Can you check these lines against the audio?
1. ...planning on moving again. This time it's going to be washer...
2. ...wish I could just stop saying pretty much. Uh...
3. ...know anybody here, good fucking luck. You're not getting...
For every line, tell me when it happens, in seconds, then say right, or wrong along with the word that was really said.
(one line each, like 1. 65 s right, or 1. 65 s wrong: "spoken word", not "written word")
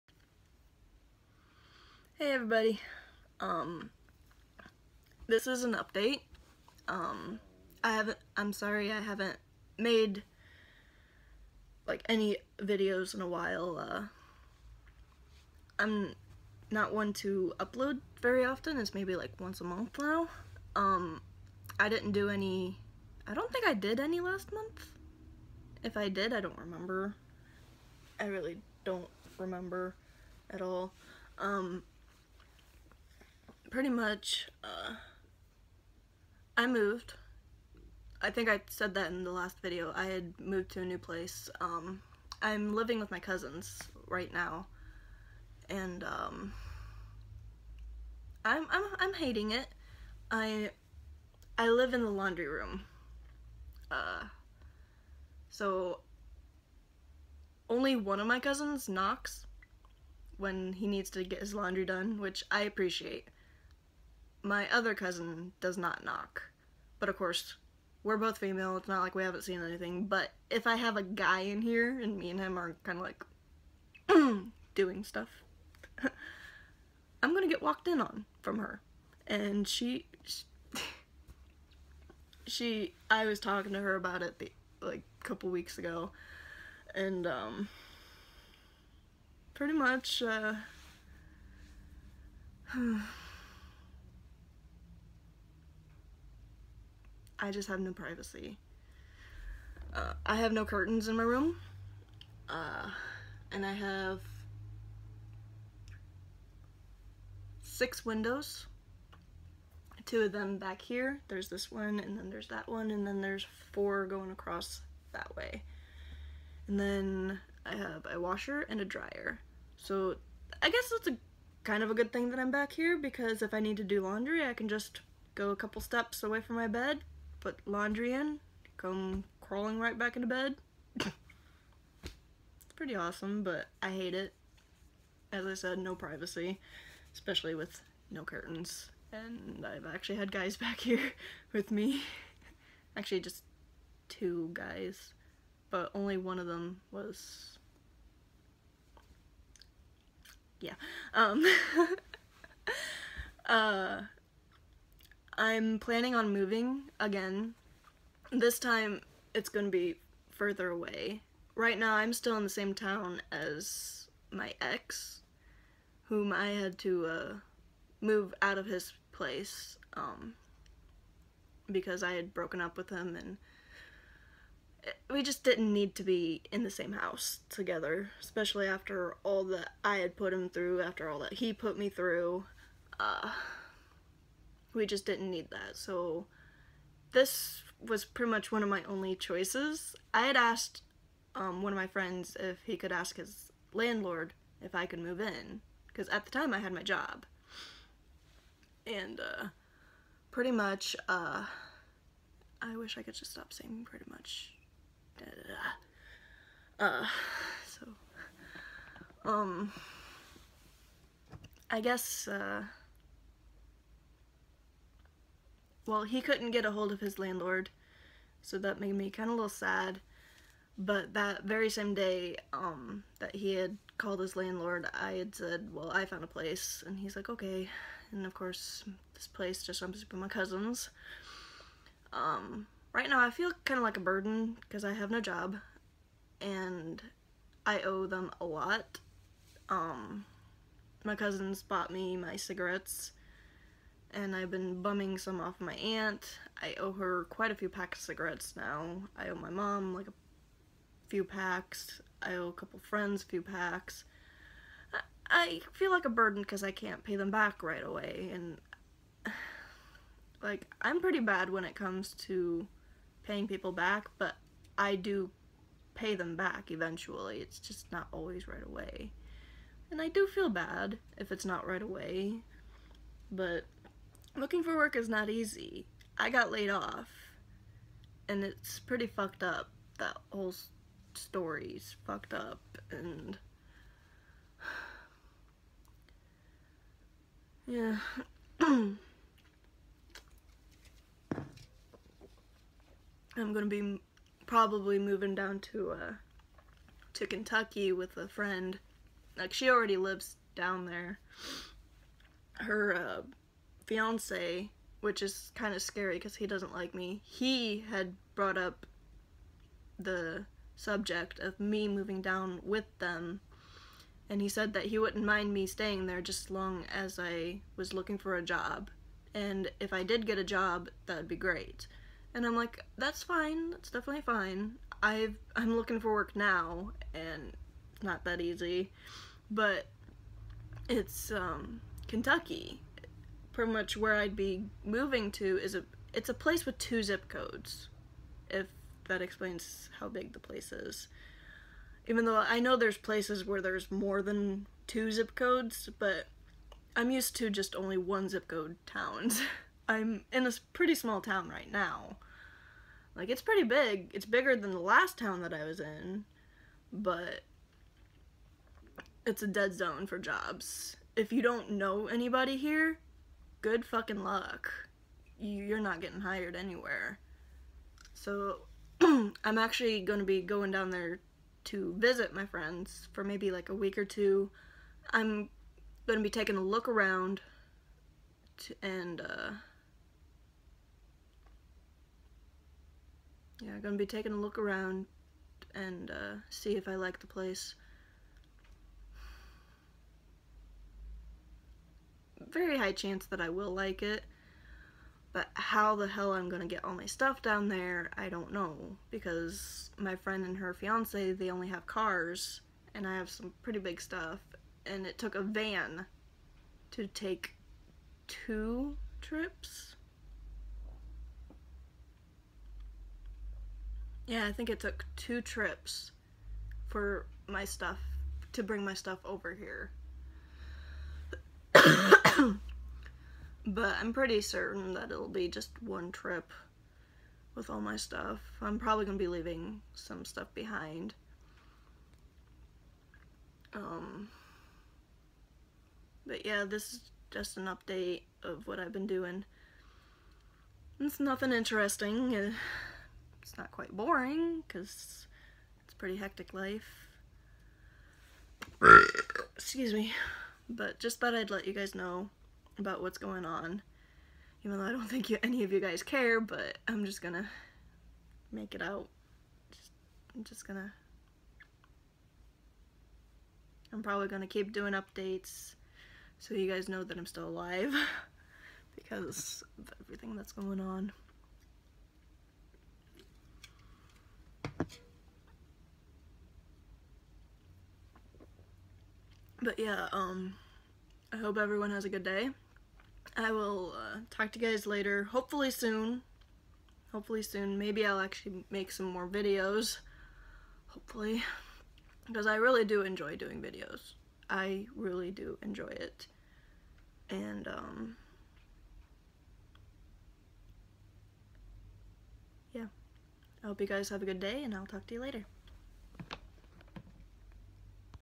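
1. 155 s wrong: "further", not "washer"
2. 202 s right
3. 361 s right.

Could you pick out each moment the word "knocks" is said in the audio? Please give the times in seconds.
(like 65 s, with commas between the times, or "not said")
58 s, 66 s.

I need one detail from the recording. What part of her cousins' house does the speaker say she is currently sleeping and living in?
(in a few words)
The laundry room.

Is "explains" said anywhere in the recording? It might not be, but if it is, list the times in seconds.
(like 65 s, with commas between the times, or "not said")
339 s.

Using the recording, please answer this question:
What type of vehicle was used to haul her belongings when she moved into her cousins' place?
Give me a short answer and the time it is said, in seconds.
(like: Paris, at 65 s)
A van, at 405 s.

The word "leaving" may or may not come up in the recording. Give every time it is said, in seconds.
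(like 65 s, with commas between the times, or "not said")
429 s.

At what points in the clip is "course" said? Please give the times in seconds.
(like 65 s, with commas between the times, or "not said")
67 s, 228 s.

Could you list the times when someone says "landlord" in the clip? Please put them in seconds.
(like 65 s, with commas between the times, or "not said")
193 s, 217 s, 224 s.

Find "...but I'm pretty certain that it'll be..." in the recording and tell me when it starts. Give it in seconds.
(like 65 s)
423 s.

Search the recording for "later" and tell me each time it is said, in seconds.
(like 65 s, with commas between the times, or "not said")
484 s, 505 s.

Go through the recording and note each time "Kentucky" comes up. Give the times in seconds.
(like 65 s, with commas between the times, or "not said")
297 s, 332 s.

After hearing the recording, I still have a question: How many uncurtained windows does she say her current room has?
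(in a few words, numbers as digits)
6.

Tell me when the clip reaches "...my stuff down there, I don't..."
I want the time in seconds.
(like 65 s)
396 s.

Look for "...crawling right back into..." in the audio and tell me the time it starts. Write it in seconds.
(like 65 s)
129 s.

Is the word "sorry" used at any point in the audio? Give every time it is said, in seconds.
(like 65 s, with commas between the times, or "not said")
8 s.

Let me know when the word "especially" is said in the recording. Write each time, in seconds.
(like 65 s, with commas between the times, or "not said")
137 s, 178 s.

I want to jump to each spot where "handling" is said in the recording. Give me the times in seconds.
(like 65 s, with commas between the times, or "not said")
not said.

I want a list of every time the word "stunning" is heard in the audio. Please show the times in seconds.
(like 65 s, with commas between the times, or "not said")
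not said.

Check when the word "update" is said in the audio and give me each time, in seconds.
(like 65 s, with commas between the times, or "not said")
5 s, 437 s, 464 s.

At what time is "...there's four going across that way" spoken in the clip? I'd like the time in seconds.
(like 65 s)
113 s.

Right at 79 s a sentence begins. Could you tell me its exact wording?
And she, she, I was talking to her about it the, like a couple weeks ago, and um, pretty much.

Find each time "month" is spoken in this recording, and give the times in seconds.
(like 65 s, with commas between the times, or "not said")
19 s, 24 s.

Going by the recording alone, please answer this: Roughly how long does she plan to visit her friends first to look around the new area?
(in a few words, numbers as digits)
A week or two.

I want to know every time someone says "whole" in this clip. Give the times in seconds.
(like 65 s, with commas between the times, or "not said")
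280 s.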